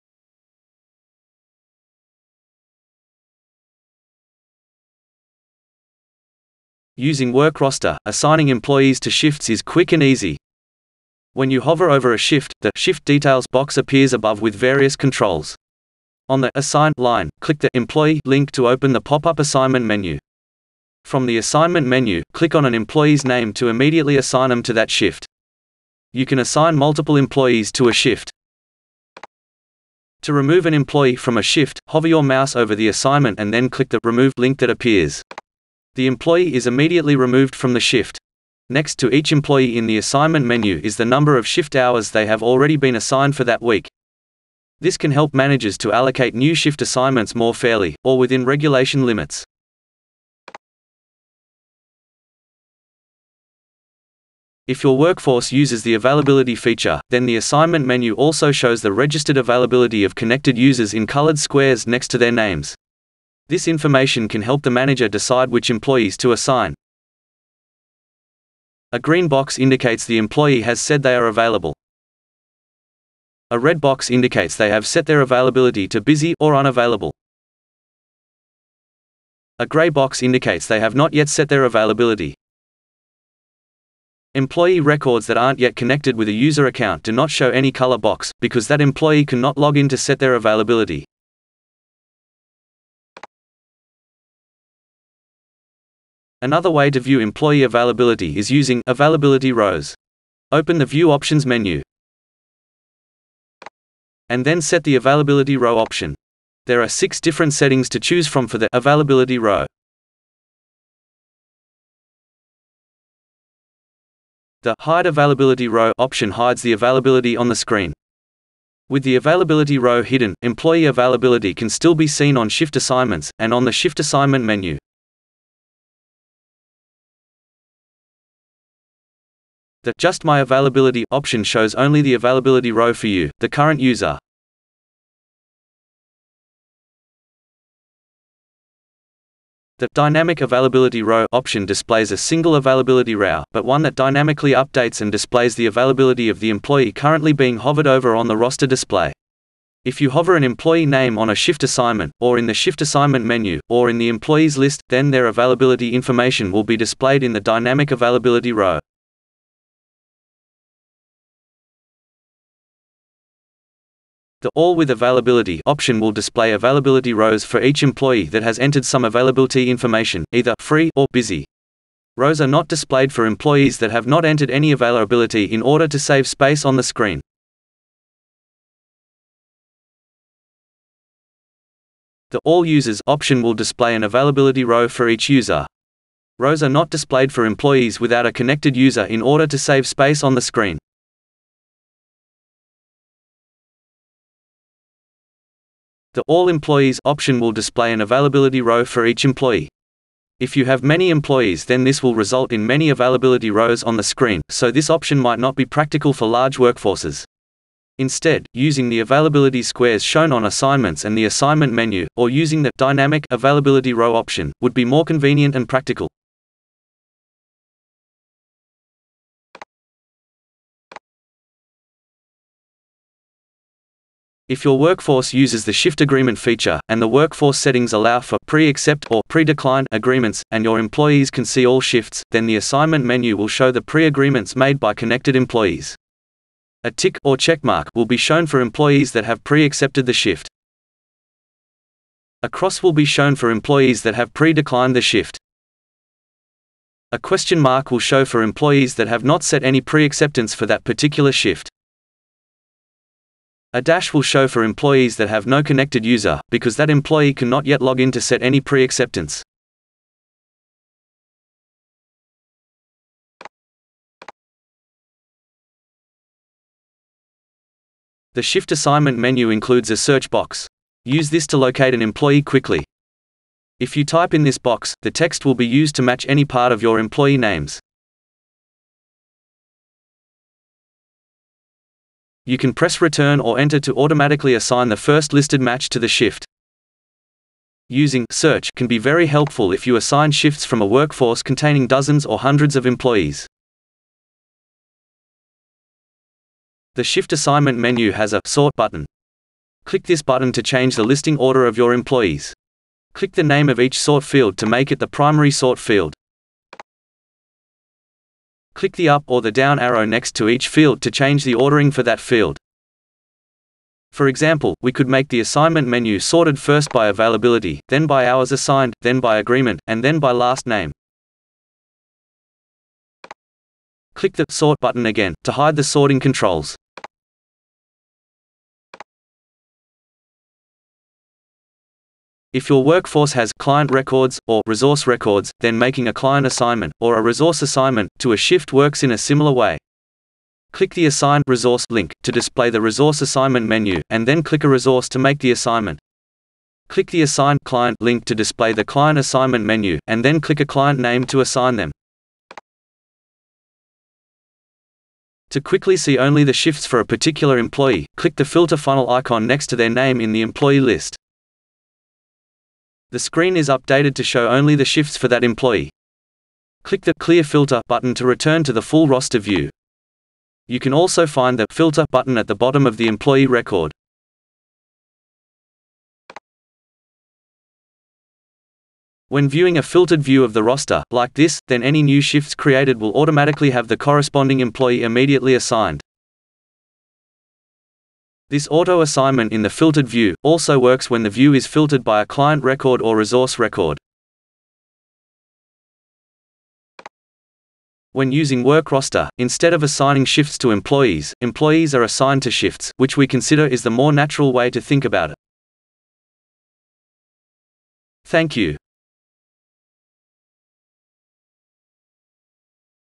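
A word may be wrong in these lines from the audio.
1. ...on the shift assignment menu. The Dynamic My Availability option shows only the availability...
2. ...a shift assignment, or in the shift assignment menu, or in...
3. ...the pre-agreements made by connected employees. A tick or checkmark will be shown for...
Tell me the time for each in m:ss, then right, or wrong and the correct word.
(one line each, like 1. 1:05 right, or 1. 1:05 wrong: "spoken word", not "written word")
1. 2:03 wrong: "Just", not "Dynamic"
2. 2:31 right
3. 3:53 right.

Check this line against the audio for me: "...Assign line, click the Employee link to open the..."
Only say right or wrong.
right.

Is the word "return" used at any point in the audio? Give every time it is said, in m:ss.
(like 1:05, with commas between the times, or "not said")
4:43, 6:08.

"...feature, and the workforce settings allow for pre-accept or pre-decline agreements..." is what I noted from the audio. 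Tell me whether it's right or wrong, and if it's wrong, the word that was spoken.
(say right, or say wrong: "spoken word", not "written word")
right.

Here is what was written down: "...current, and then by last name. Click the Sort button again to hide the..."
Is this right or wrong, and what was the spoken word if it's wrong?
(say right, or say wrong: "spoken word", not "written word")
wrong: "agreement", not "current".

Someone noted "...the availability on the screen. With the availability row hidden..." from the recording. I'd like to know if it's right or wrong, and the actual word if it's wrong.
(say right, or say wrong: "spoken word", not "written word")
right.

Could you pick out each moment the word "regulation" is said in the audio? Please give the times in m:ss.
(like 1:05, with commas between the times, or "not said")
0:48.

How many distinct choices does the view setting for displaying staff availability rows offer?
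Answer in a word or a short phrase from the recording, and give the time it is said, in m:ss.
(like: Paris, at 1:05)
6, at 1:46.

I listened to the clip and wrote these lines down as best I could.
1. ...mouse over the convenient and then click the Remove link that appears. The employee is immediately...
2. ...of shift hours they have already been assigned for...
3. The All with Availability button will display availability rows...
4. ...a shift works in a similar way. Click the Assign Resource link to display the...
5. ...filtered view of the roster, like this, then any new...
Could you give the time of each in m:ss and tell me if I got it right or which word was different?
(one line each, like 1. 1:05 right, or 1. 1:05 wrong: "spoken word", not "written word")
1. 0:32 wrong: "assignment", not "convenient"
2. 0:41 right
3. 2:44 wrong: "option", not "button"
4. 5:38 right
5. 6:19 right.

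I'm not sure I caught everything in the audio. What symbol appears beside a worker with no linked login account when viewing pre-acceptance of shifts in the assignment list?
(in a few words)
A dash.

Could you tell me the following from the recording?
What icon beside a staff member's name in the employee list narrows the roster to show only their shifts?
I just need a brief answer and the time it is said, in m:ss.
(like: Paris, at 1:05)
Filter funnel icon, at 5:58.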